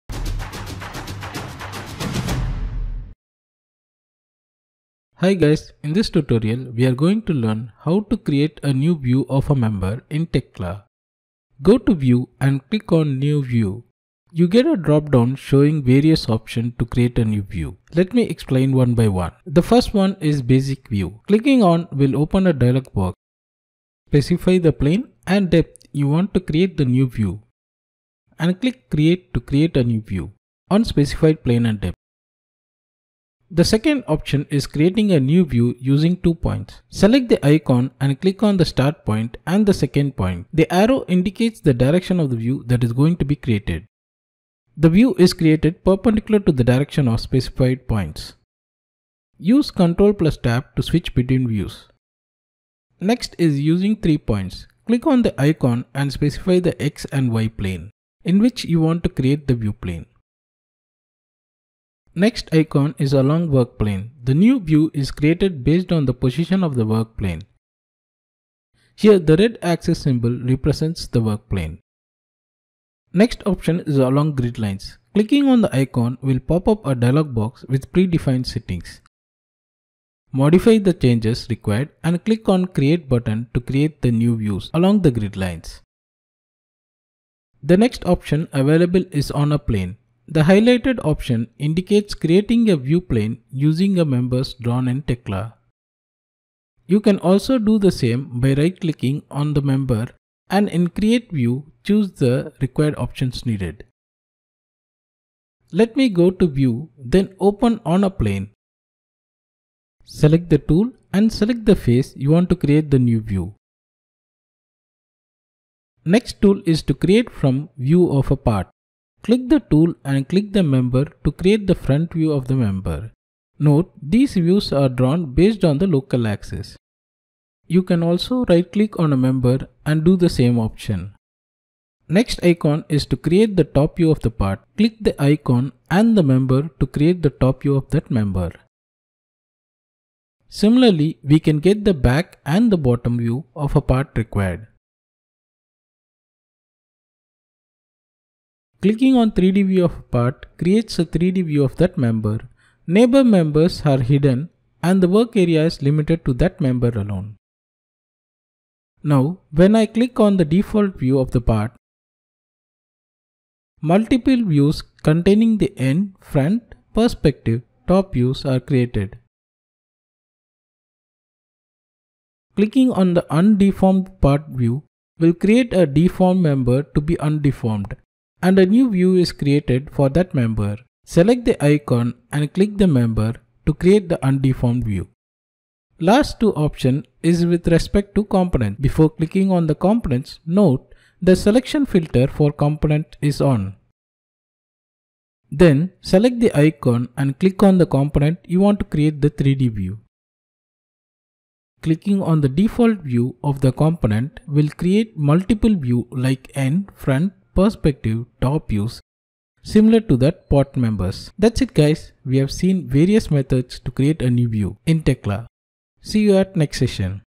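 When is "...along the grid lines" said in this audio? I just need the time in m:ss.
1:24.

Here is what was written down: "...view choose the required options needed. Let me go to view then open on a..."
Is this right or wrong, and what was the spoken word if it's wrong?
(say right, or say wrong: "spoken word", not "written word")
right.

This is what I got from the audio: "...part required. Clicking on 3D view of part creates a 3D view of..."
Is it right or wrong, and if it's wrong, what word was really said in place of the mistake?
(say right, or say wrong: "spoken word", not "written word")
right.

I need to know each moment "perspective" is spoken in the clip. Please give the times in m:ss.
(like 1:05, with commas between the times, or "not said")
2:46, 3:27.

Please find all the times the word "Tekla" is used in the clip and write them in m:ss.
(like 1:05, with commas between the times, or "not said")
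0:10, 1:35, 3:35.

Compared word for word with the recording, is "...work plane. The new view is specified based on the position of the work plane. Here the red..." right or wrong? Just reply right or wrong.
wrong.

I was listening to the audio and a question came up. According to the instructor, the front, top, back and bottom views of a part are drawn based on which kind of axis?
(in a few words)
Local axis.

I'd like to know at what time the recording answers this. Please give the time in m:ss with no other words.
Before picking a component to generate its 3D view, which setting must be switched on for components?
3:11.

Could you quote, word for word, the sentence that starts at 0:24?
Specify the plane and depth you want to create the new view.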